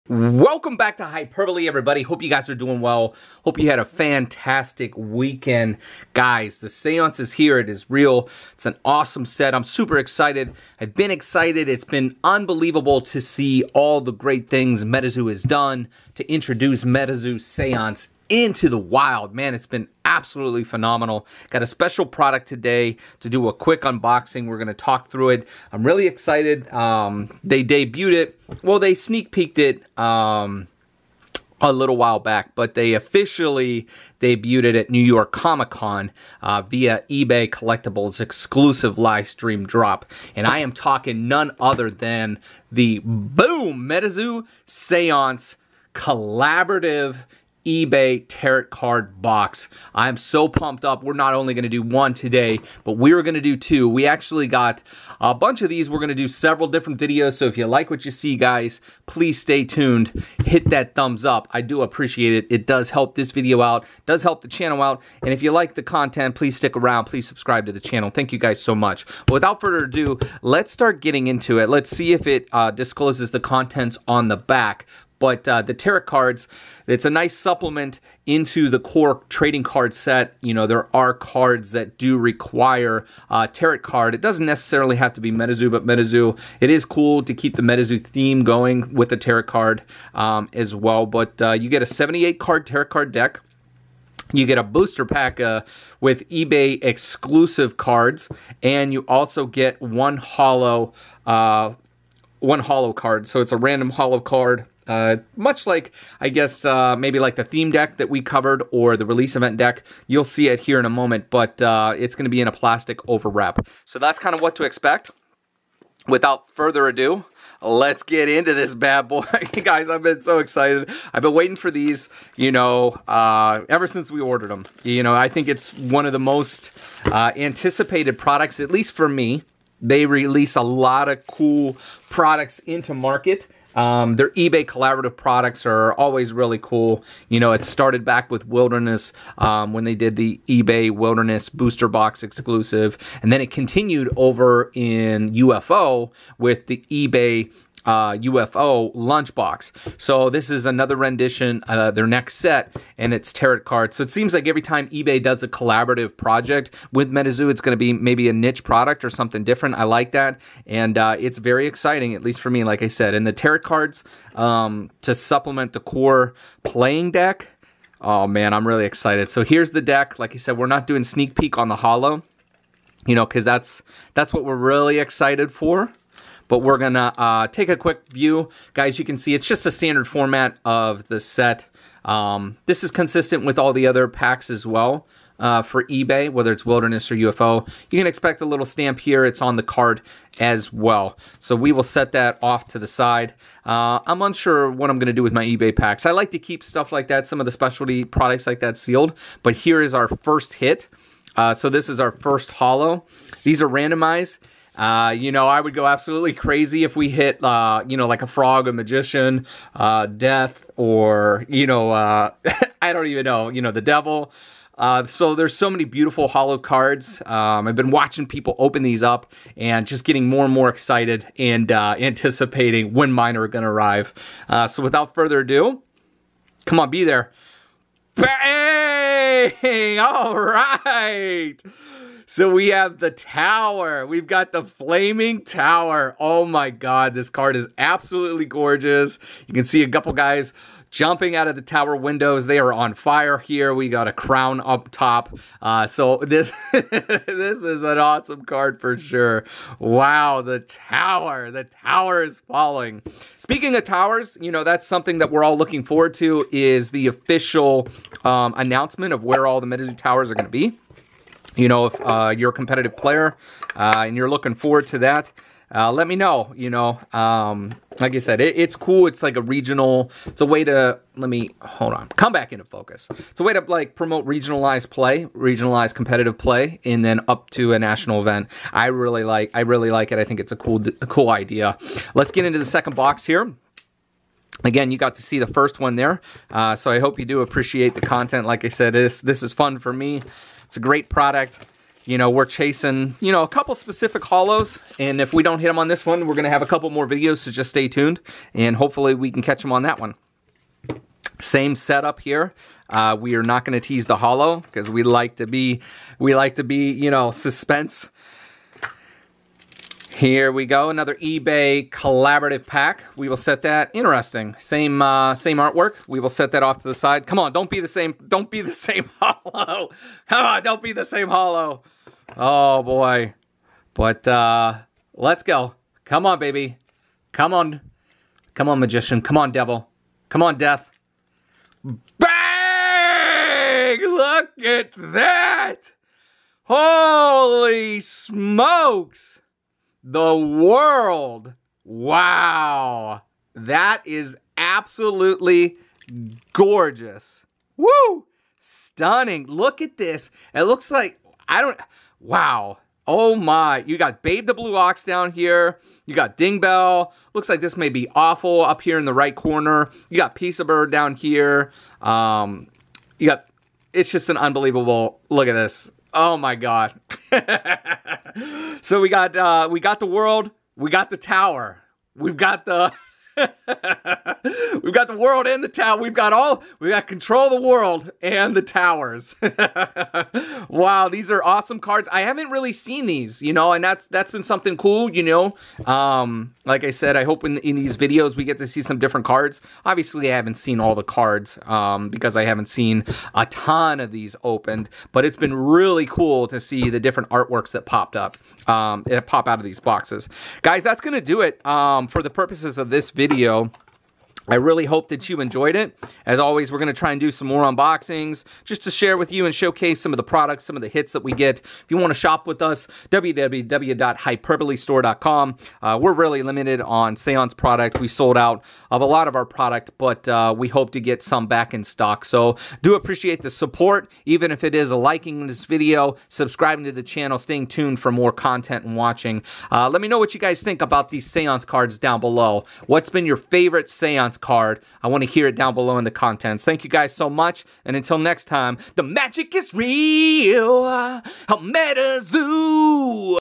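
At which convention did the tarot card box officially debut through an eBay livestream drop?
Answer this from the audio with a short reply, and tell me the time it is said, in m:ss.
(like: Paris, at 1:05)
New York Comic Con, at 0:34.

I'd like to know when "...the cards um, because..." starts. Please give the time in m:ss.
6:30.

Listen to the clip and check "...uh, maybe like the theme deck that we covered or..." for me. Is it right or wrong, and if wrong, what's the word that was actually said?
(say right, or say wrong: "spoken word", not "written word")
right.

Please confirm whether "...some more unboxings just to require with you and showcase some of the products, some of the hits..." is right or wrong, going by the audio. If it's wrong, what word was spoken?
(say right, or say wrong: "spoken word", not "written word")
wrong: "share", not "require".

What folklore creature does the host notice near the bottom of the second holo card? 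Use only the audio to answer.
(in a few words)
Babe the Blue Ox.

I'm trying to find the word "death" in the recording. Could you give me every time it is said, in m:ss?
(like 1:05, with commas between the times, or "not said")
3:30, 5:30.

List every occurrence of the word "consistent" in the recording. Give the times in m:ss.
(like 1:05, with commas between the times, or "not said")
3:02.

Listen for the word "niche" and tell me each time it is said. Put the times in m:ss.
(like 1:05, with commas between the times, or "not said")
2:38.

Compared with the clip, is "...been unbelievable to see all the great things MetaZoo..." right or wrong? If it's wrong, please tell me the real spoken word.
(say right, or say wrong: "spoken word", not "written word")
right.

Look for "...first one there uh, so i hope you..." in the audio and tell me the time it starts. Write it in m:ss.
4:45.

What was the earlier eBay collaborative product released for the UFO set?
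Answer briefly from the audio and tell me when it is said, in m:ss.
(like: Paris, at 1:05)
lunchbox, at 2:26.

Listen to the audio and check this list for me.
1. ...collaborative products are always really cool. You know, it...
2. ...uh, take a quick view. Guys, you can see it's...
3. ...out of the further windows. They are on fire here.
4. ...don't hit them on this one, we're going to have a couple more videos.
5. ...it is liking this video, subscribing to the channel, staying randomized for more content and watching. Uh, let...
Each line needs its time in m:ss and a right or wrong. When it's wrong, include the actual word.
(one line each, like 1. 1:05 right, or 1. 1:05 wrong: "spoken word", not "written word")
1. 2:14 right
2. 2:57 right
3. 4:01 wrong: "tower", not "further"
4. 4:55 right
5. 7:04 wrong: "tuned", not "randomized".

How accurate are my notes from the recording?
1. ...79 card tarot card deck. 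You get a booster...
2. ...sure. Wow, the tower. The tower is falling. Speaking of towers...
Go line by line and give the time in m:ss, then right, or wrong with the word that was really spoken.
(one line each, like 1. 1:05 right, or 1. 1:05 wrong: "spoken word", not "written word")
1. 1:31 wrong: "78", not "79"
2. 4:08 right.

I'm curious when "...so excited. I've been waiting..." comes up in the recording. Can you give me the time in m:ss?
2:00.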